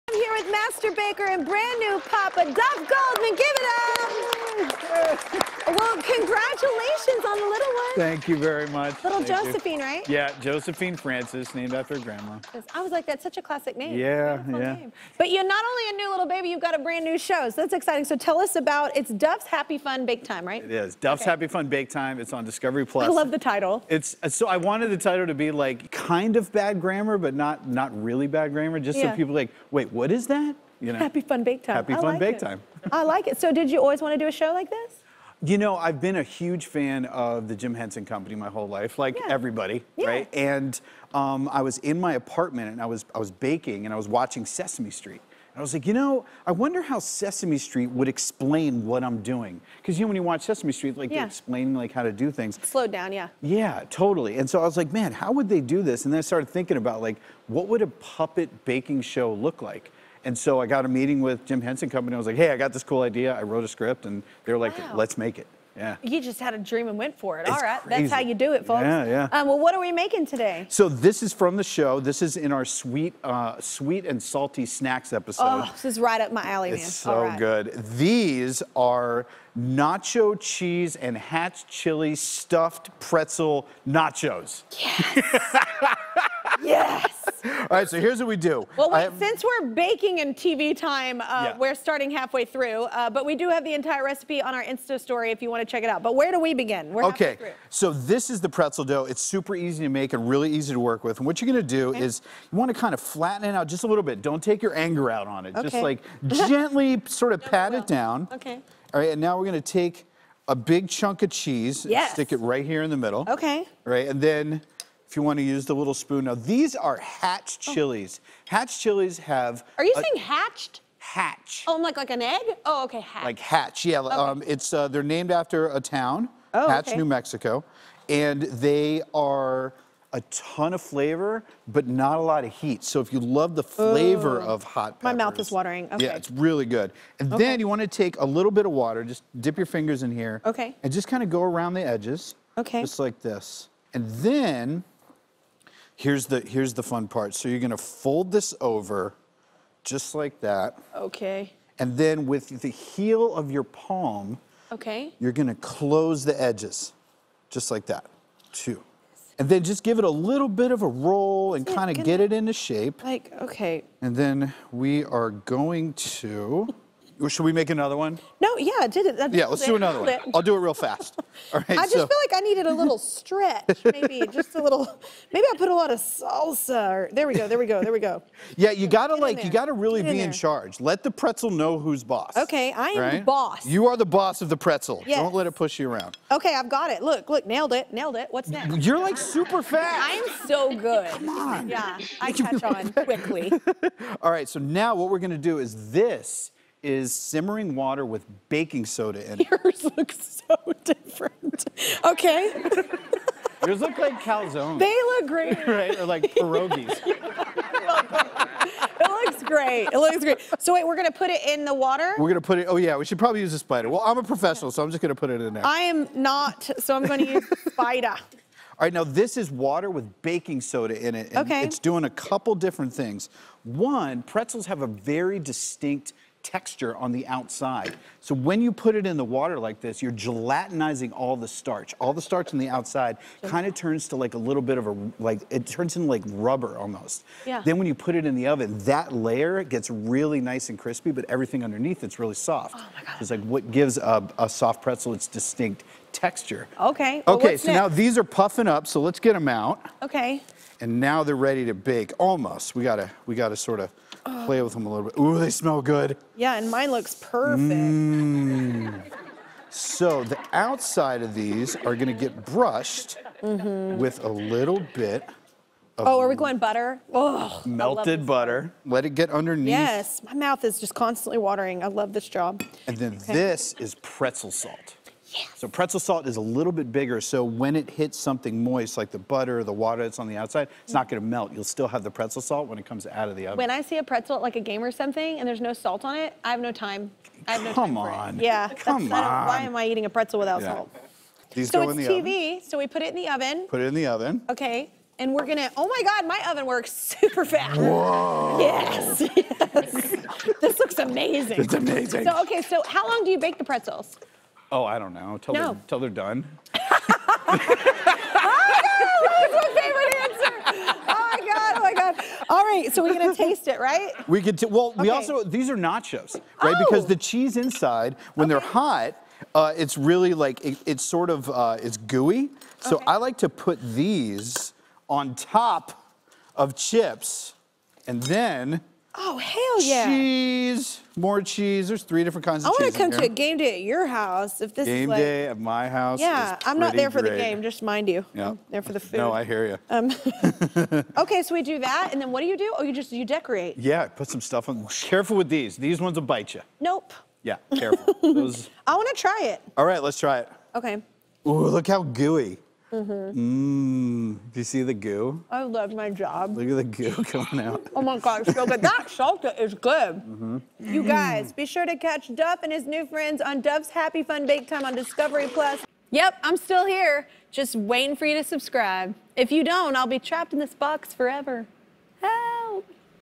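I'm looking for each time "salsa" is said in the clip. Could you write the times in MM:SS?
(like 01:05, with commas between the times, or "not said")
02:55, 05:59.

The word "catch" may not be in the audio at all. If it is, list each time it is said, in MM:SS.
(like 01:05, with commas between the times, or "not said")
03:12, 06:02.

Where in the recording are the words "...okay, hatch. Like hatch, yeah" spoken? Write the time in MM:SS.
02:02.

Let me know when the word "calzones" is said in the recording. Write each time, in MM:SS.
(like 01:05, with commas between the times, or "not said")
03:24.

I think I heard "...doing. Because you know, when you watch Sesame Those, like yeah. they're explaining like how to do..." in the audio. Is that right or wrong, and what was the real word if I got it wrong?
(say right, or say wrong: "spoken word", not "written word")
wrong: "Street", not "Those".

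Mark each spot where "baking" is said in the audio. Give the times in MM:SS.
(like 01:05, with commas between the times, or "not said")
00:43, 00:58, 01:29, 03:18, 03:40.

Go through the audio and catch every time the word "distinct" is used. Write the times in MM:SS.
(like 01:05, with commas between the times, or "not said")
03:45, 04:05.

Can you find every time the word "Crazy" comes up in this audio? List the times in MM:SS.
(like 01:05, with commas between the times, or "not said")
01:07.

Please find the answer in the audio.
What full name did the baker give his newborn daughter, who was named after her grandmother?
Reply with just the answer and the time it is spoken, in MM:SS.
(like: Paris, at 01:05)
Josephine Francis, at 00:10.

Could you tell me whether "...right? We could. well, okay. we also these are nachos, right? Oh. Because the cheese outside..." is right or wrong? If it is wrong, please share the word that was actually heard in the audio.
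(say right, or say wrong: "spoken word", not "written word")
wrong: "inside", not "outside".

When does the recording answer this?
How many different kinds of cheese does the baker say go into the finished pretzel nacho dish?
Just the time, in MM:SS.
05:32.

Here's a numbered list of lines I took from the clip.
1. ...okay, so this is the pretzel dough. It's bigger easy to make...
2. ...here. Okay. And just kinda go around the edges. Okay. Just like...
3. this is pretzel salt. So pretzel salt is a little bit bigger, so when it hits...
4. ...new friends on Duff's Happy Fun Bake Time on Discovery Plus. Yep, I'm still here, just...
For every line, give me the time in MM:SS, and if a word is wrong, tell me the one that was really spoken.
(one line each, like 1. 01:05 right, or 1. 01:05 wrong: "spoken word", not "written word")
1. 01:37 wrong: "super", not "bigger"
2. 02:20 right
3. 04:33 right
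4. 06:02 right.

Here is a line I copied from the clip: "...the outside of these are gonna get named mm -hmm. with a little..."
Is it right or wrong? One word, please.
wrong.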